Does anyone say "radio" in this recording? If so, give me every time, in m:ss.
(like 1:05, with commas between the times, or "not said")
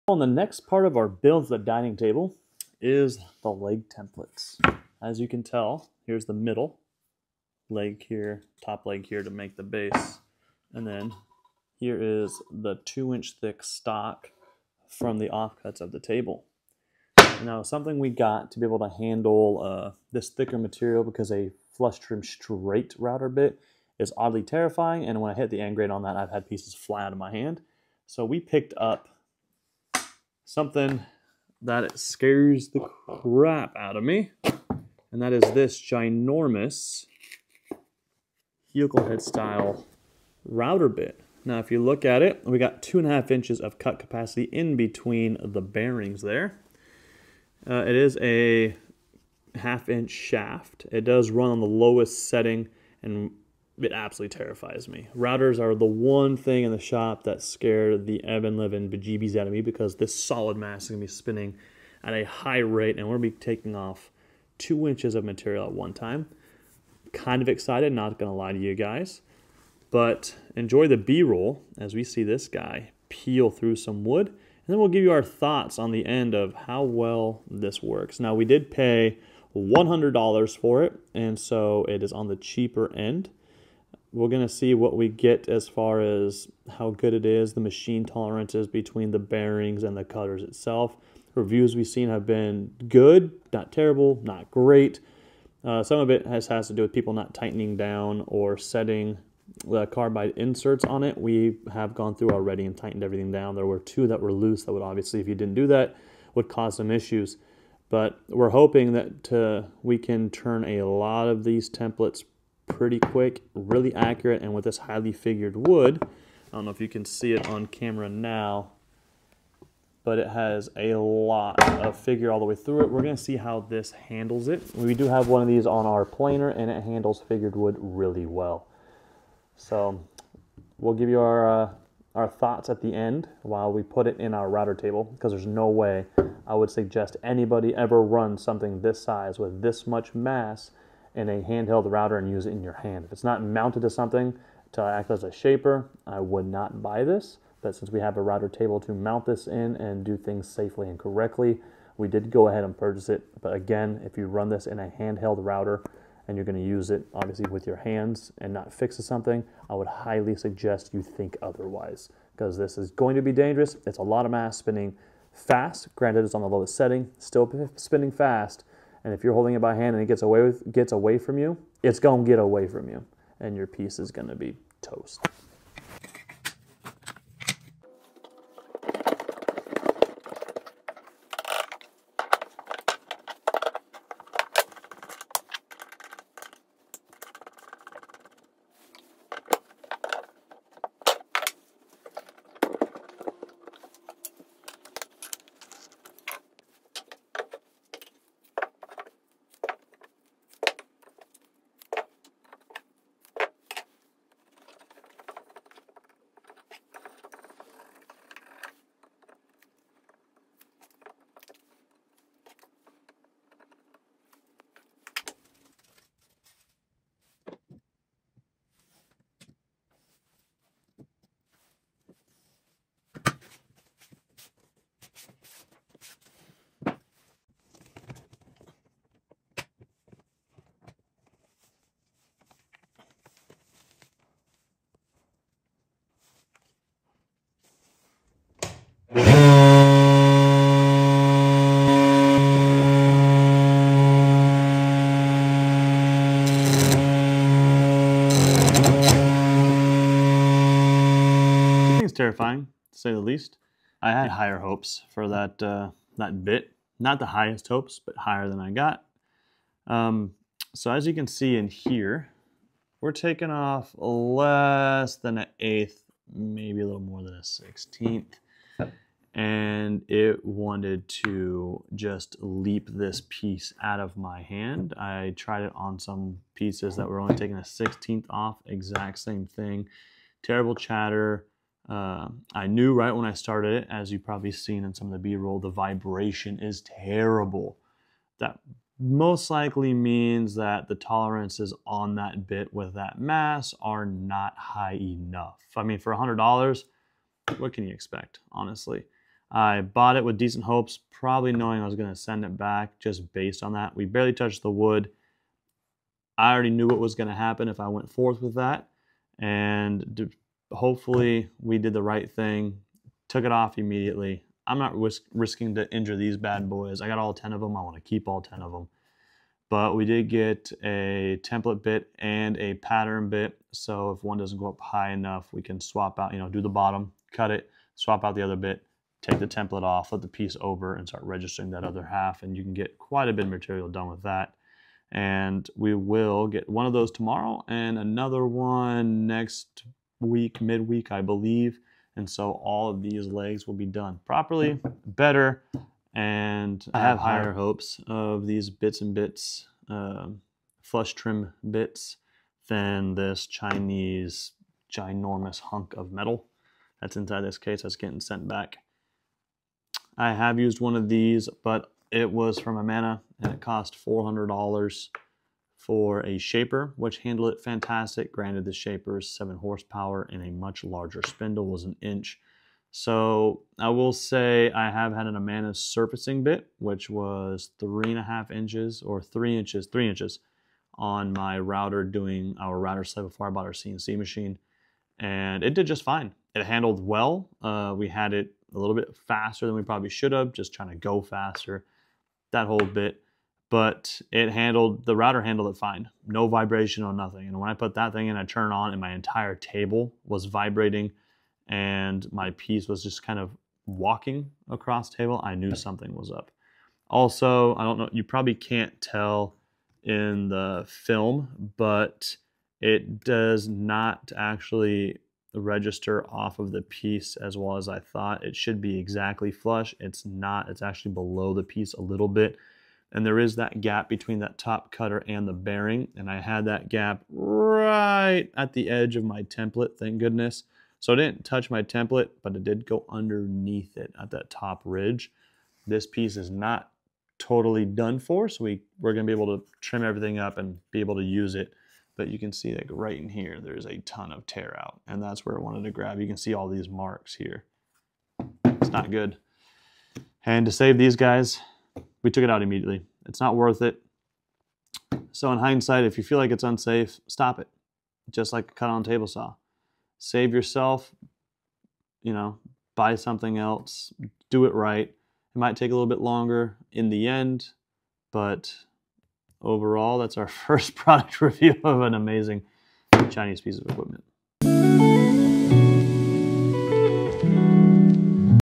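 not said.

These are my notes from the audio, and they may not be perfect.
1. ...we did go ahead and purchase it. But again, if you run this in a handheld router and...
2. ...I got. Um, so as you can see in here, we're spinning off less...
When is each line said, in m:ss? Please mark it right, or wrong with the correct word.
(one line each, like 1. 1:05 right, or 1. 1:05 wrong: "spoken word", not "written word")
1. 2:31 right
2. 4:18 wrong: "taking", not "spinning".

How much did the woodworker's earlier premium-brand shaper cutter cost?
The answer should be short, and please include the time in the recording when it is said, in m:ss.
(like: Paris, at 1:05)
$400, at 6:04.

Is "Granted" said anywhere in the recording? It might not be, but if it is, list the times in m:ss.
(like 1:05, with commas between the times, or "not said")
2:45, 6:08.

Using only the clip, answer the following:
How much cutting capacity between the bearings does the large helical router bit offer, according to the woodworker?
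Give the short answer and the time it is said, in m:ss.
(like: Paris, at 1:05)
2.5 inches, at 0:42.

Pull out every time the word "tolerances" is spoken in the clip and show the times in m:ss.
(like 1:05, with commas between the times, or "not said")
1:28, 4:50.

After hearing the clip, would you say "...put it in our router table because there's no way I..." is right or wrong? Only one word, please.
right.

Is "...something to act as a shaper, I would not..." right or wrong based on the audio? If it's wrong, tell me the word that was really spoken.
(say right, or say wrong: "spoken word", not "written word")
right.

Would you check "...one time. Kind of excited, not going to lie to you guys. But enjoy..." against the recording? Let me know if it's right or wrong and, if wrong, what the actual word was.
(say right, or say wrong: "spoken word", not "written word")
right.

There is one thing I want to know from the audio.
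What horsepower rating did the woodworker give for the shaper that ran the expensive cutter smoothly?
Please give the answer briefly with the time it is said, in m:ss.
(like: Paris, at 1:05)
7, at 6:09.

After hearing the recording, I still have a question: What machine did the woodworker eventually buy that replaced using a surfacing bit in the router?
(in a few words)
CNC machine.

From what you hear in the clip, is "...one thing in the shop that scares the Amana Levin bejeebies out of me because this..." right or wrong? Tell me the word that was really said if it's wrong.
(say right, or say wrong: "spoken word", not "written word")
wrong: "Evan", not "Amana".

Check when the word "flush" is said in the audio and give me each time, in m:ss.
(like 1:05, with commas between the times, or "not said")
0:21, 5:50, 6:59.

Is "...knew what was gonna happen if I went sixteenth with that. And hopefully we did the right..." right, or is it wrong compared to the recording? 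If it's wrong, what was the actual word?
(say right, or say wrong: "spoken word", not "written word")
wrong: "forth", not "sixteenth".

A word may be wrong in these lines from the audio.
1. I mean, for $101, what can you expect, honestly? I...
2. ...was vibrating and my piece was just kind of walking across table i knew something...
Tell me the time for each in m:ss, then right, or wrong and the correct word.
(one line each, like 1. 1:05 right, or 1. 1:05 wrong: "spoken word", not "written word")
1. 4:55 wrong: "100", not "101"
2. 6:40 right.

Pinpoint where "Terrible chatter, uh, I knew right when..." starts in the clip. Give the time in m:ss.
4:40.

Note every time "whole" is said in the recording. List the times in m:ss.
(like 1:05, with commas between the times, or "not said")
6:32.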